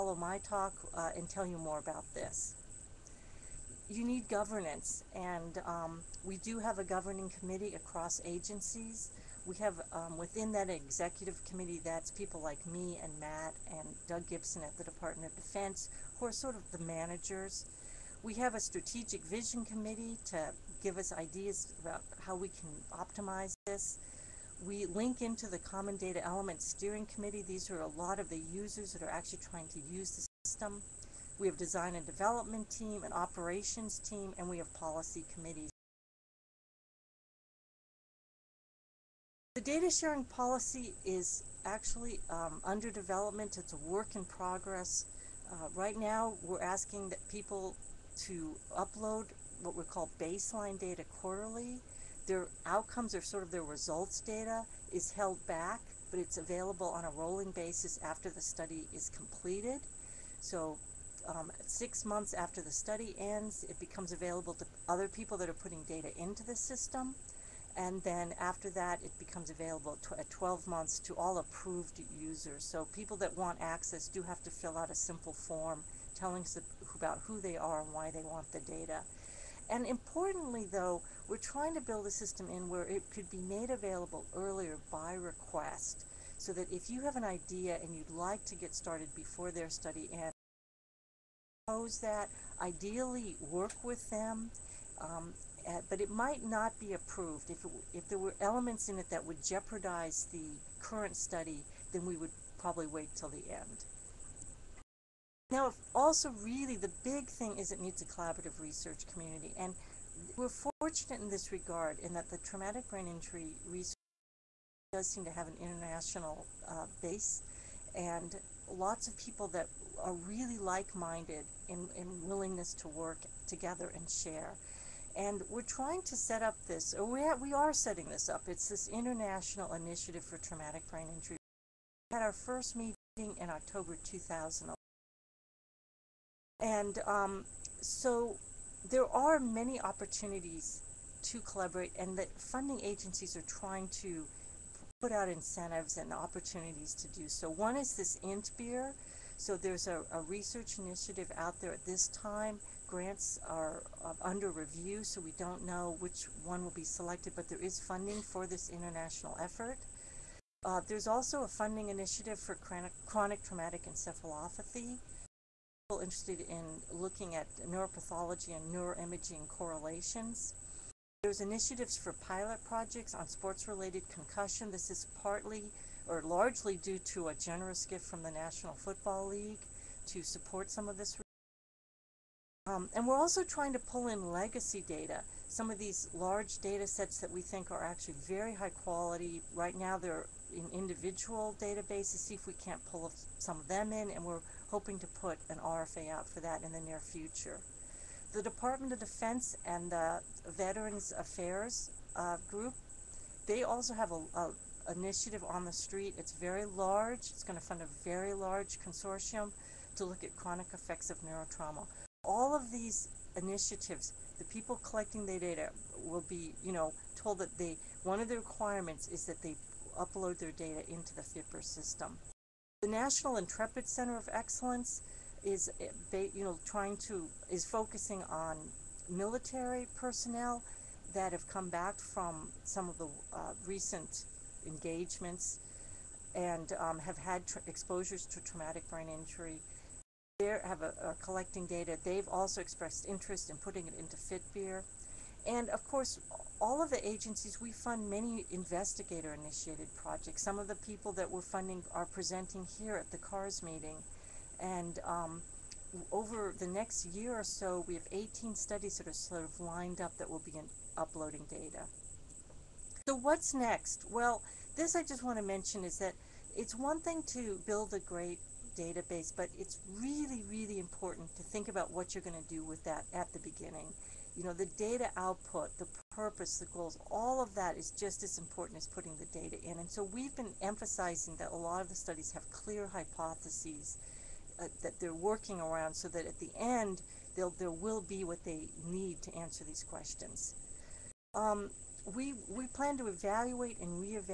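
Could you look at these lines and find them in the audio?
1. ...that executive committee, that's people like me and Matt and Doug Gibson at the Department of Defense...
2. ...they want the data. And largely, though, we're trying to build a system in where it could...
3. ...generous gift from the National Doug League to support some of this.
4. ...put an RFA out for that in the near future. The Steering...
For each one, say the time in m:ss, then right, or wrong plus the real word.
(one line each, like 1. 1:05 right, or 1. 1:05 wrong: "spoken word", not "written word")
1. 0:10 right
2. 1:18 wrong: "importantly", not "largely"
3. 2:57 wrong: "Football", not "Doug"
4. 3:15 wrong: "Department", not "Steering".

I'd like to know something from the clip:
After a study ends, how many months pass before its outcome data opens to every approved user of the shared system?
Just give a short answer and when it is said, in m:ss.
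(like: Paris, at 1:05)
12 months, at 1:10.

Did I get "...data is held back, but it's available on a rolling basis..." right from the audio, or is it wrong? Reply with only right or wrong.
right.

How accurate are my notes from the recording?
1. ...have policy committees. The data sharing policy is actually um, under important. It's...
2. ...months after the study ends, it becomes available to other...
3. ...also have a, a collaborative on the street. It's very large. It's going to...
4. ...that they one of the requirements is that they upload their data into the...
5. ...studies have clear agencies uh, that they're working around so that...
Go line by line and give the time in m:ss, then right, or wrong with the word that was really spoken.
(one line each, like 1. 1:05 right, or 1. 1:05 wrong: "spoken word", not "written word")
1. 0:34 wrong: "development", not "important"
2. 1:02 right
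3. 3:23 wrong: "initiative", not "collaborative"
4. 3:37 right
5. 4:41 wrong: "hypotheses", not "agencies".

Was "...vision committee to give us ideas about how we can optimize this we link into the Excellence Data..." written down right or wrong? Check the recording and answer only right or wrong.
wrong.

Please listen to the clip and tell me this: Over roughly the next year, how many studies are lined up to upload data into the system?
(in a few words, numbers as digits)
18.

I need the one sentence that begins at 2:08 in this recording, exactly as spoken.
It's this international initiative for traumatic brain injury.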